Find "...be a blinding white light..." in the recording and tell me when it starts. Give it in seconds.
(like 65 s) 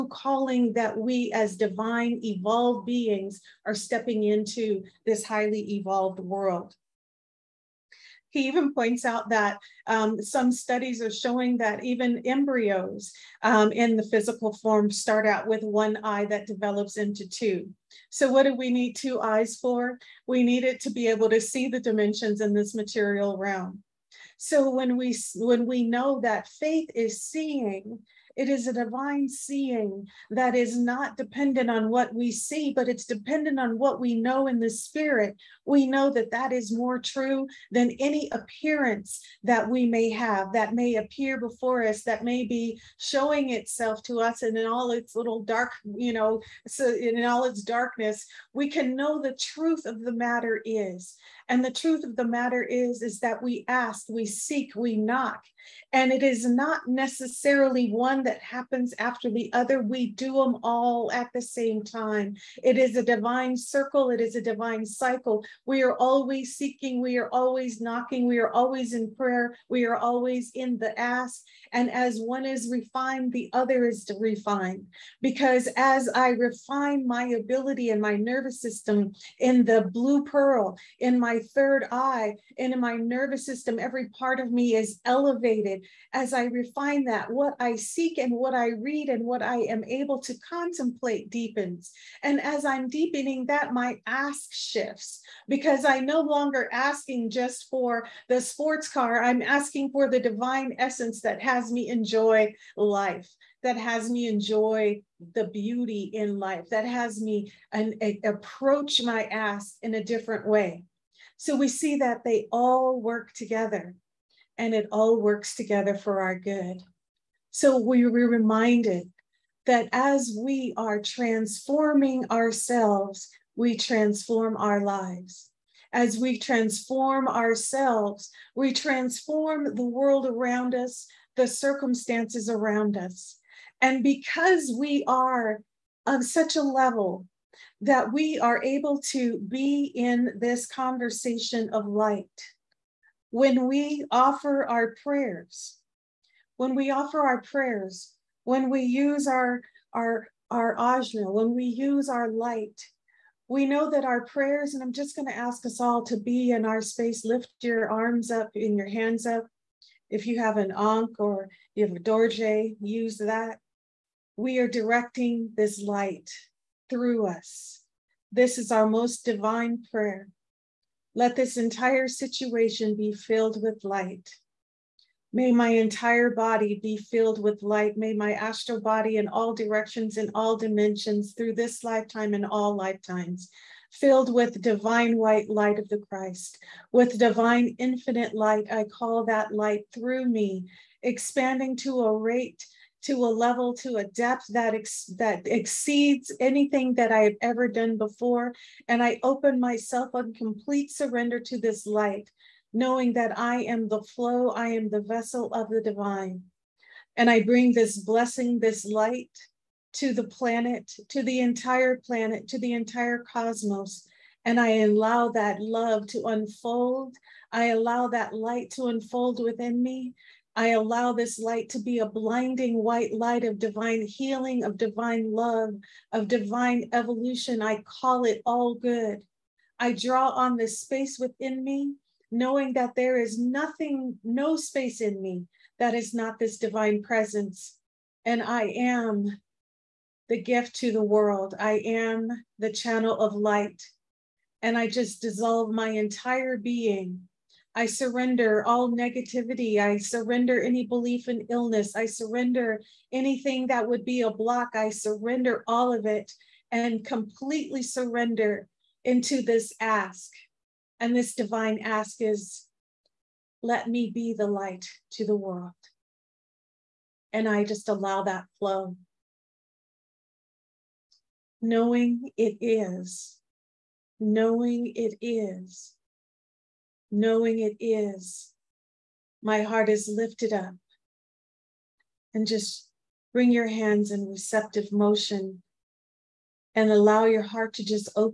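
221 s.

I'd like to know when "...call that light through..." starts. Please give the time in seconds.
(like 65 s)
188 s.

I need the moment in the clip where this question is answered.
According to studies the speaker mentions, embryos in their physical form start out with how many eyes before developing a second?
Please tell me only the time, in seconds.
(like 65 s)
15 s.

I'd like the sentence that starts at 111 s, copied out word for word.
So we see that they all work together and it all works together for our good.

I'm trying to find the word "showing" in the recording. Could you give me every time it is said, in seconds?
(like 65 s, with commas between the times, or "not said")
11 s, 42 s.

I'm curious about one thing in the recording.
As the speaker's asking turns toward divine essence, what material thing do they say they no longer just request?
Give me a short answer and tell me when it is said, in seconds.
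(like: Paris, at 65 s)
sports car, at 98 s.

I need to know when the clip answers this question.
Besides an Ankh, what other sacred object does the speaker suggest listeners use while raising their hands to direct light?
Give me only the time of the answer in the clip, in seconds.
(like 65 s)
161 s.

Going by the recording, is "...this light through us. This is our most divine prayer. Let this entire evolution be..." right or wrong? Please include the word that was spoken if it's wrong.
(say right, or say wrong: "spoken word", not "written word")
wrong: "situation", not "evolution".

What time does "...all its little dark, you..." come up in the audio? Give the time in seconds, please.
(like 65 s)
44 s.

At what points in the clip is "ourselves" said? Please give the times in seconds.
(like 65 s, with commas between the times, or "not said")
122 s, 127 s.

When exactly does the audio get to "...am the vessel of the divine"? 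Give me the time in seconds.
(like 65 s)
204 s.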